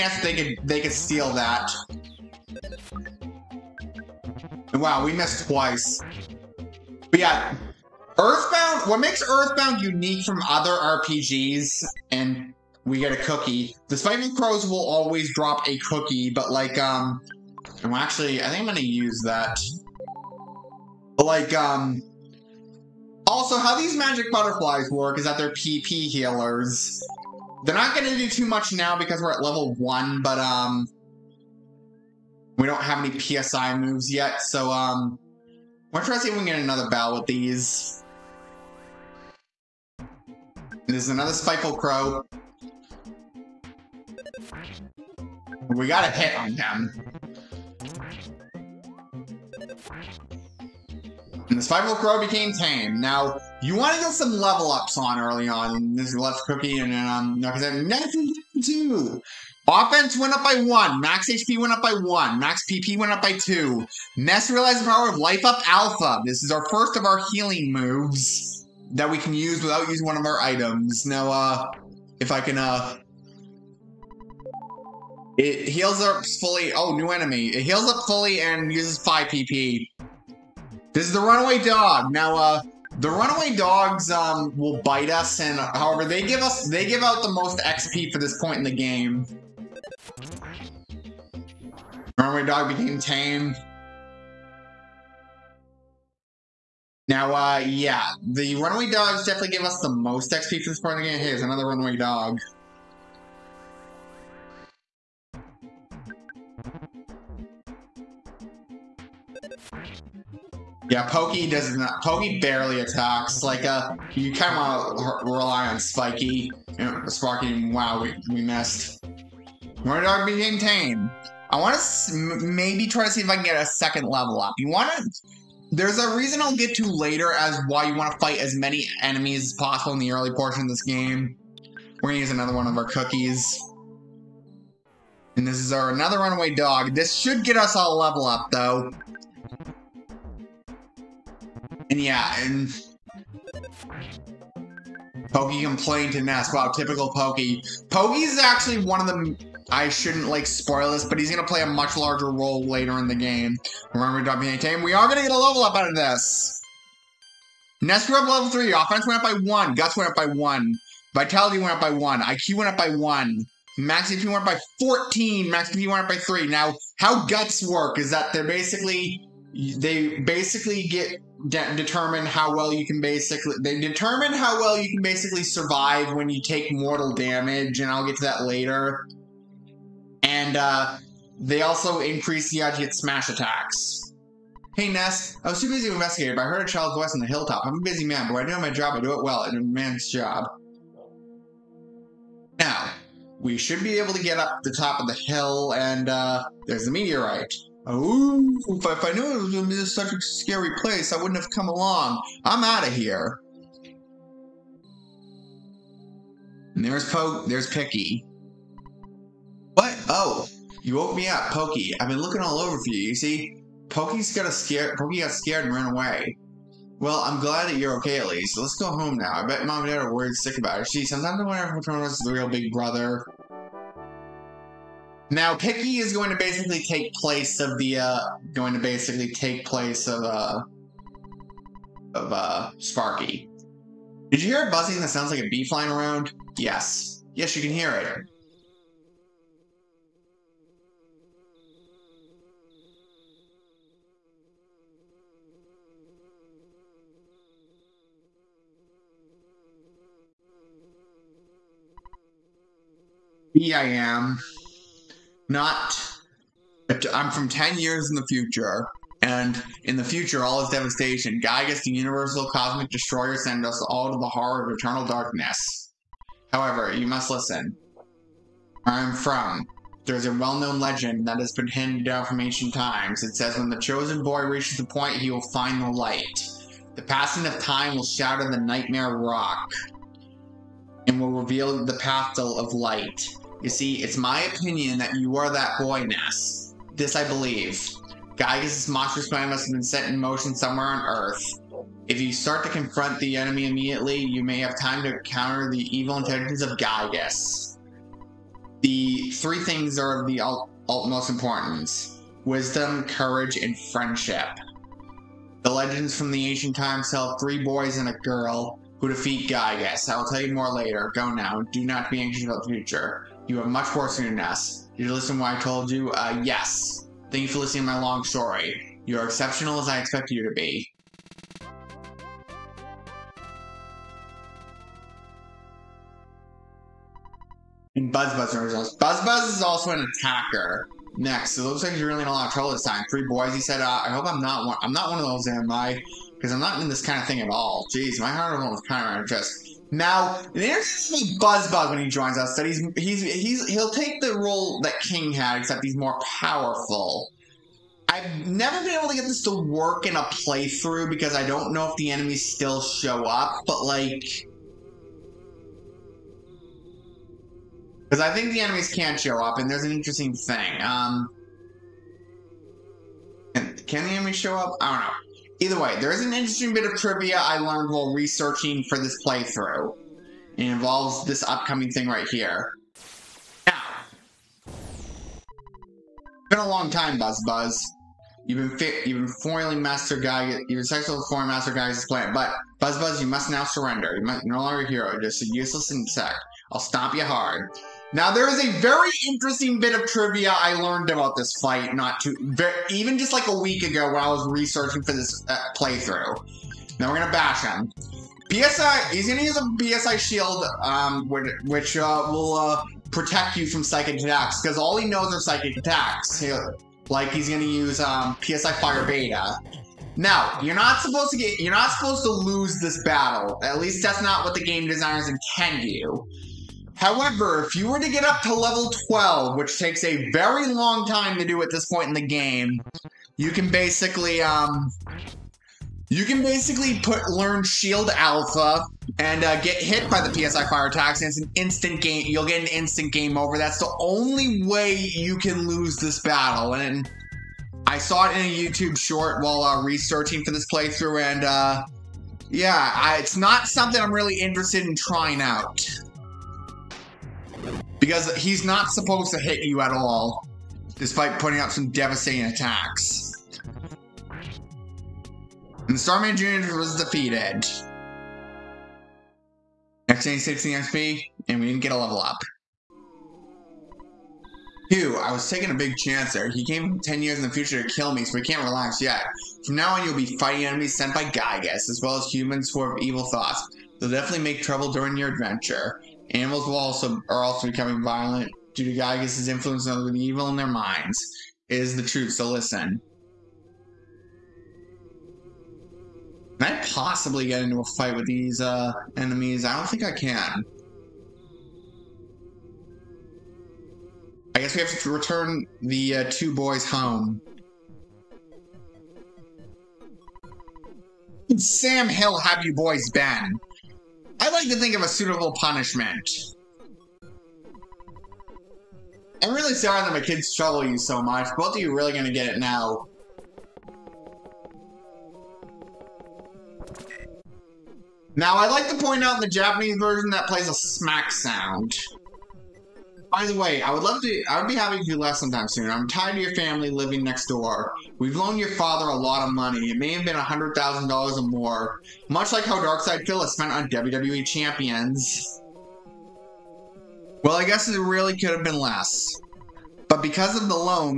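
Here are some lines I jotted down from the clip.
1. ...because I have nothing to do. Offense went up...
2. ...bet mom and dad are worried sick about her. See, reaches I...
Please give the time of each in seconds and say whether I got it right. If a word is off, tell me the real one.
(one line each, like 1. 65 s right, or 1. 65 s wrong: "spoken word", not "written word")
1. 57 s right
2. 219 s wrong: "sometimes", not "reaches".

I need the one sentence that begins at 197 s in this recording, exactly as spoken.
Ooh, if, if I knew it was going to be such a scary place, I wouldn't have come along.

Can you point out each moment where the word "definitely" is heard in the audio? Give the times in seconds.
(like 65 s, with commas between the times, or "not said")
99 s, 474 s.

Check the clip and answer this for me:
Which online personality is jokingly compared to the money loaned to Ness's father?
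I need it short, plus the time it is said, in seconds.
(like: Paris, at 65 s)
DarksydePhil, at 532 s.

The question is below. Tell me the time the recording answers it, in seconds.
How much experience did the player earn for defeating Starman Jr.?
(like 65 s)
460 s.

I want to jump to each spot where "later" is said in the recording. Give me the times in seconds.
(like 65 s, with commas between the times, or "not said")
126 s, 152 s, 178 s, 310 s.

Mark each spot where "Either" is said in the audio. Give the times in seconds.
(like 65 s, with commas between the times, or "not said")
365 s.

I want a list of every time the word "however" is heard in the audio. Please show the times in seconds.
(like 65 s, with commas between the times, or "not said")
85 s, 266 s, 416 s.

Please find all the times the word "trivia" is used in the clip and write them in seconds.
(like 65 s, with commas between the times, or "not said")
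366 s, 390 s.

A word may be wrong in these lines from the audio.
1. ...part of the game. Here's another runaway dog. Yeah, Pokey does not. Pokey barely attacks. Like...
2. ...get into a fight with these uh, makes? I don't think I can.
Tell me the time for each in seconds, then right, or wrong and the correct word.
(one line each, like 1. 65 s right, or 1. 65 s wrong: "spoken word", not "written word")
1. 100 s right
2. 487 s wrong: "enemies", not "makes".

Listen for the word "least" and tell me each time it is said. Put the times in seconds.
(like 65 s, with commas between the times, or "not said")
218 s, 413 s.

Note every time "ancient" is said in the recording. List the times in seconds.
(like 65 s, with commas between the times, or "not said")
272 s, 306 s.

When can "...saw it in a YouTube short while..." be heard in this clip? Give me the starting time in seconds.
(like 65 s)
437 s.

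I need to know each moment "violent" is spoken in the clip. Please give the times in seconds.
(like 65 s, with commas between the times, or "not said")
478 s.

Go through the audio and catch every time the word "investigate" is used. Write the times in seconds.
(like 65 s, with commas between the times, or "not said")
185 s.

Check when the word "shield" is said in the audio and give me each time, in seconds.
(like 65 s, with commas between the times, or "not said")
400 s, 427 s.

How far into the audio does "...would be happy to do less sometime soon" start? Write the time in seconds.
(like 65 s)
524 s.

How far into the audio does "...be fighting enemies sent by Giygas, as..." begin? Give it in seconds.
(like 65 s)
470 s.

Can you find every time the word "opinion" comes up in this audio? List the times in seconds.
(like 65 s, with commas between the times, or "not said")
284 s.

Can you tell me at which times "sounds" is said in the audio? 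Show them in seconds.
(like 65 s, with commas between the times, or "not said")
235 s, 521 s.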